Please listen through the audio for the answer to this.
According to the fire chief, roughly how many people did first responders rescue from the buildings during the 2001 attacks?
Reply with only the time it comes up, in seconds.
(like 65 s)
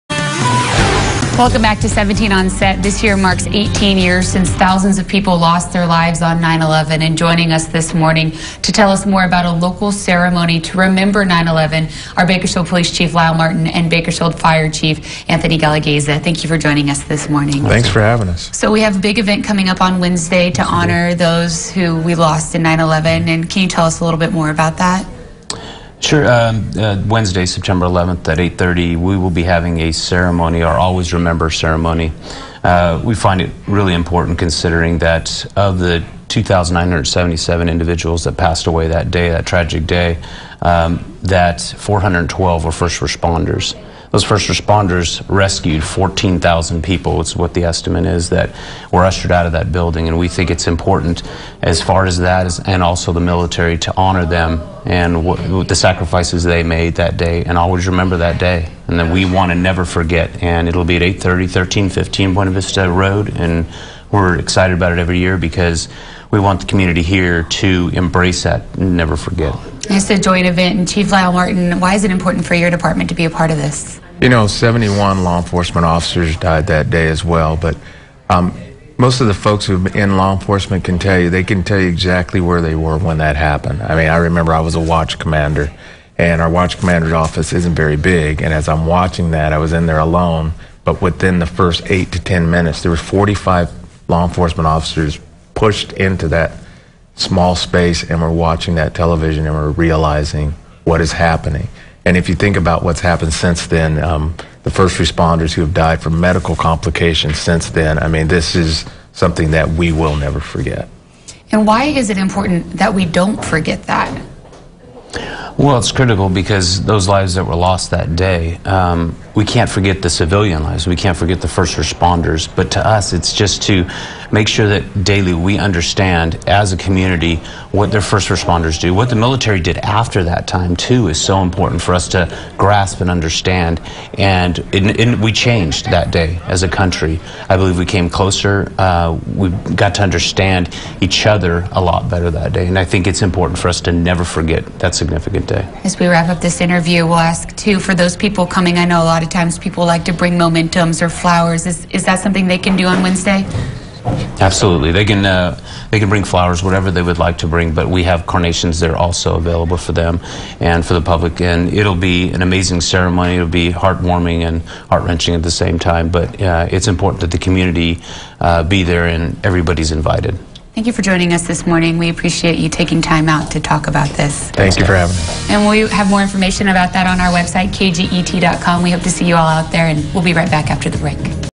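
45 s.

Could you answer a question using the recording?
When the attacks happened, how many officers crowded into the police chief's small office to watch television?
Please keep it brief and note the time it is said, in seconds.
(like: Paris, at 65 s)
45, at 92 s.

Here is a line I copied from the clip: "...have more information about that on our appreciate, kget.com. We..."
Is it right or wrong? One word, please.
wrong.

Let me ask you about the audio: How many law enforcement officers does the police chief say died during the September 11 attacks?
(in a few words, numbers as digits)
71.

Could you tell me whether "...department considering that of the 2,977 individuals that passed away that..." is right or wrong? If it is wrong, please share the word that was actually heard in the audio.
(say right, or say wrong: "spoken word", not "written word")
wrong: "important", not "department".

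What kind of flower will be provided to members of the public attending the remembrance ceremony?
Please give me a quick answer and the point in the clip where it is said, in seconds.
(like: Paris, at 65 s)
Carnations, at 158 s.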